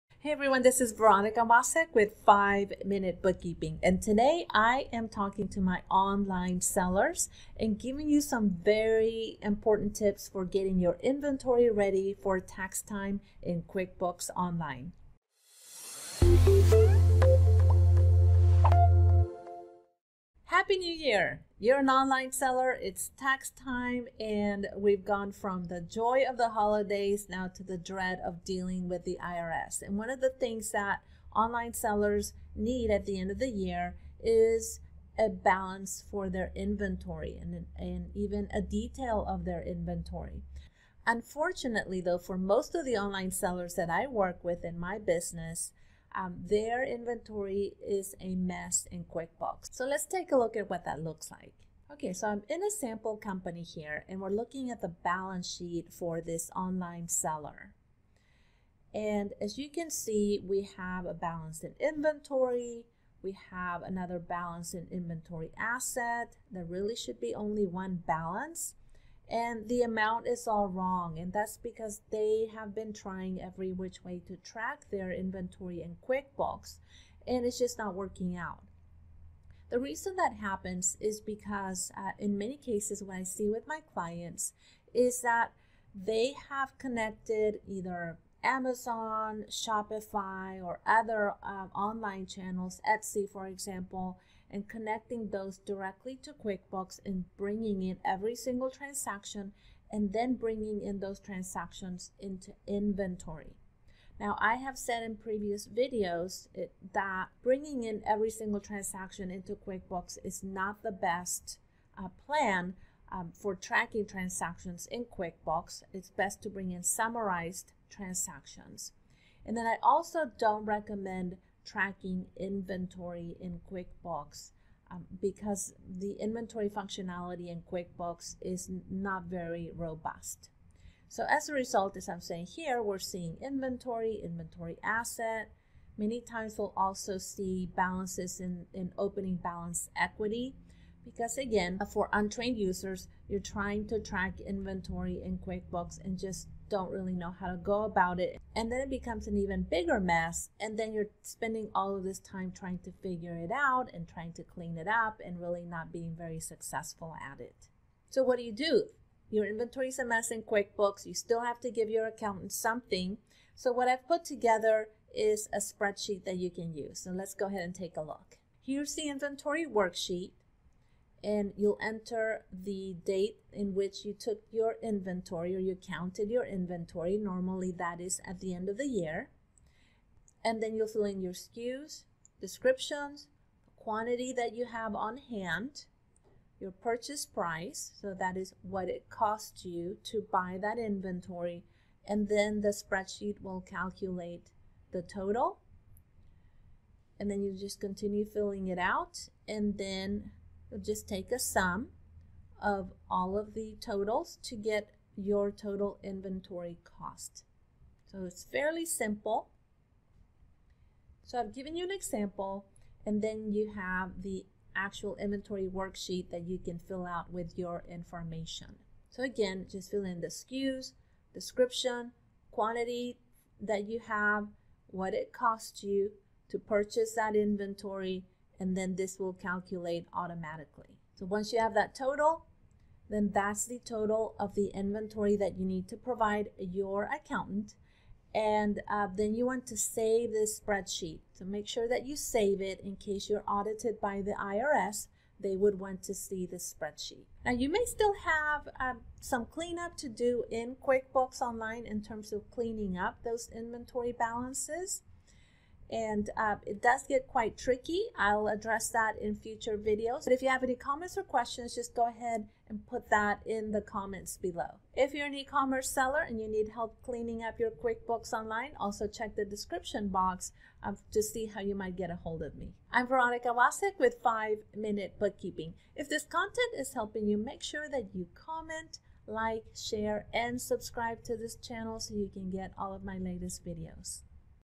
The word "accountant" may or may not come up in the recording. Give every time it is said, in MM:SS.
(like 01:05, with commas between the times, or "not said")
02:42, 03:57.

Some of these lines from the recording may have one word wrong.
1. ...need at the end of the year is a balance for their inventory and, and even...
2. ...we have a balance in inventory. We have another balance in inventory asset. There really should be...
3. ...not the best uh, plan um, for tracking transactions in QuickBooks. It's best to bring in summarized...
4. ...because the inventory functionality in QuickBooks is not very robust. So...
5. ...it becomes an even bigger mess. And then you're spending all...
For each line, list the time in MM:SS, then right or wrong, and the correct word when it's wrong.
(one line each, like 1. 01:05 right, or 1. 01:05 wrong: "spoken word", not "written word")
1. 00:32 right
2. 01:00 right
3. 01:50 right
4. 02:05 right
5. 02:28 right.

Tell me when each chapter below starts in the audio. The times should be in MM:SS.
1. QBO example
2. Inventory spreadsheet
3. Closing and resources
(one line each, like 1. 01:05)
1. 00:52
2. 02:38
3. 04:38.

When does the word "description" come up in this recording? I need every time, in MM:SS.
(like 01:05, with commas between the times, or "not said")
03:02, 03:41, 04:29.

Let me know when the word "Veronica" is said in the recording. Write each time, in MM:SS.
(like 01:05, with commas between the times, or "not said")
00:00, 04:33.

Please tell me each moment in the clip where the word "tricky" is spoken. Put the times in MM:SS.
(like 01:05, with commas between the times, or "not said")
04:17.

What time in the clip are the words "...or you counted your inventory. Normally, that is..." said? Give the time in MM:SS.
02:55.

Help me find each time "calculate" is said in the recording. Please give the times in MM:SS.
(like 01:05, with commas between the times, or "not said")
03:13, 03:49.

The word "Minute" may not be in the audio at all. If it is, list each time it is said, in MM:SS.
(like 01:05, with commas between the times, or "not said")
00:02, 04:34.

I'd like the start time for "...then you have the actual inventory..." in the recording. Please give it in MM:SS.
03:33.